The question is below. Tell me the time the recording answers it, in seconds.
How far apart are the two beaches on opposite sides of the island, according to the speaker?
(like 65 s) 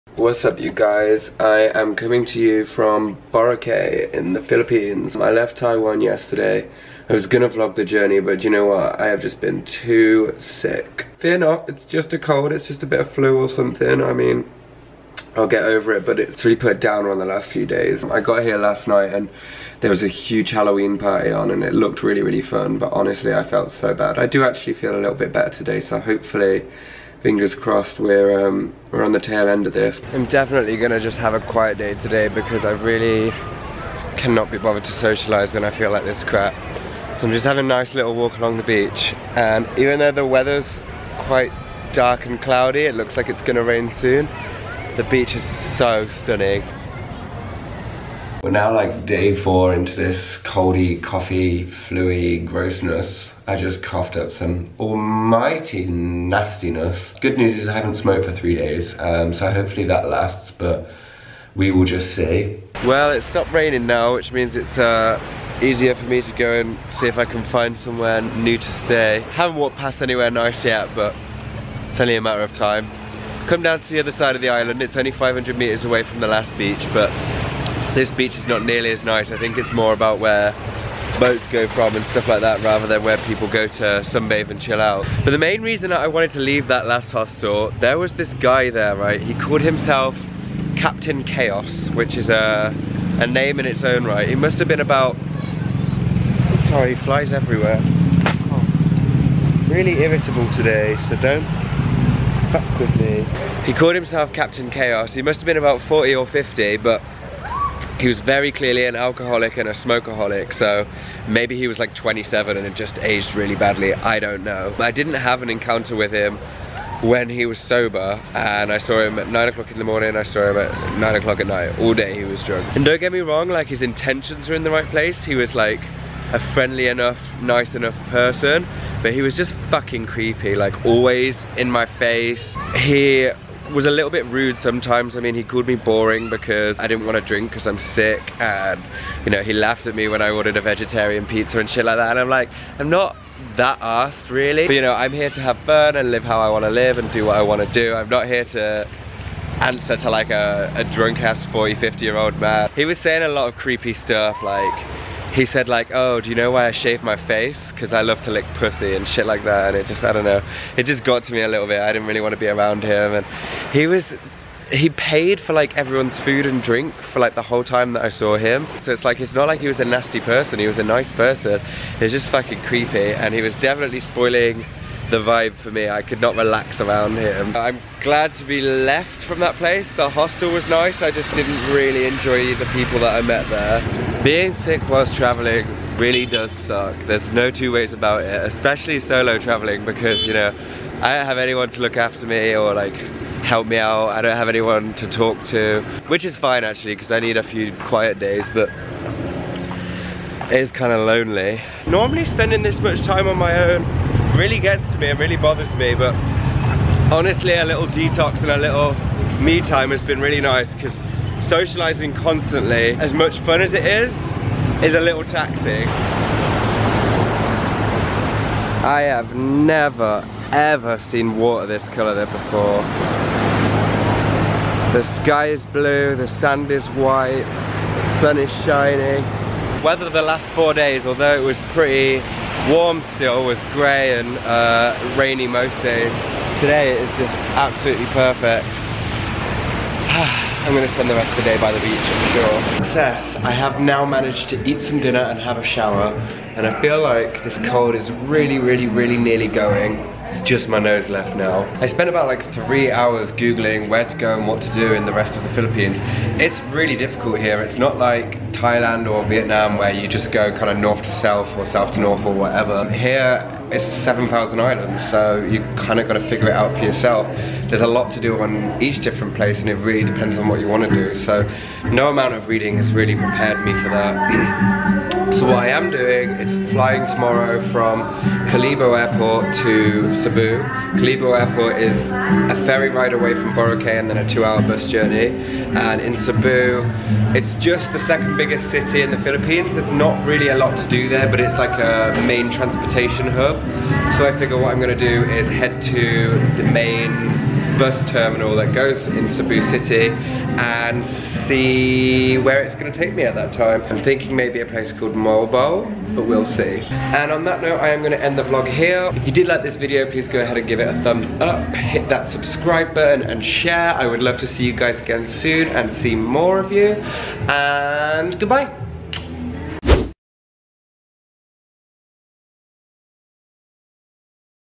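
75 s.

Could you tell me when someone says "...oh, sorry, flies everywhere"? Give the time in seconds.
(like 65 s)
95 s.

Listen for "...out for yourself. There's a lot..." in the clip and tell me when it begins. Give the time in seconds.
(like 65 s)
266 s.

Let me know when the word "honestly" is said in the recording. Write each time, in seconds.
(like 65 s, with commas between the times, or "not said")
22 s, 207 s.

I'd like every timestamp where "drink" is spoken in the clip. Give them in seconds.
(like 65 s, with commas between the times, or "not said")
137 s, 166 s.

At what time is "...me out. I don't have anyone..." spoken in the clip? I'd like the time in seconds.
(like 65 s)
193 s.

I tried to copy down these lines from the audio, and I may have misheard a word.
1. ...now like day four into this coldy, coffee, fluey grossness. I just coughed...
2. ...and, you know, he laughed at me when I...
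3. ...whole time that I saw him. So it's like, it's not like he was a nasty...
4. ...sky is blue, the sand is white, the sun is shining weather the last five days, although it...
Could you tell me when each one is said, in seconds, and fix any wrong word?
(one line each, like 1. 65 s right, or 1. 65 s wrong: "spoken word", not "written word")
1. 48 s right
2. 138 s right
3. 167 s right
4. 225 s wrong: "four", not "five".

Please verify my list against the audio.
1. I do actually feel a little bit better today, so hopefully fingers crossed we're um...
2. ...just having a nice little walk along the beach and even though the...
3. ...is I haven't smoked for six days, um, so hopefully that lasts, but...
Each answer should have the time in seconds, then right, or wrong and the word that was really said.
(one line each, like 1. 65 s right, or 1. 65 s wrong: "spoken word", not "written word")
1. 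24 s right
2. 37 s right
3. 57 s wrong: "three", not "six".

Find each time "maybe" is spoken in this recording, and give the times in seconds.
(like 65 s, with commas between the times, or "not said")
111 s, 304 s.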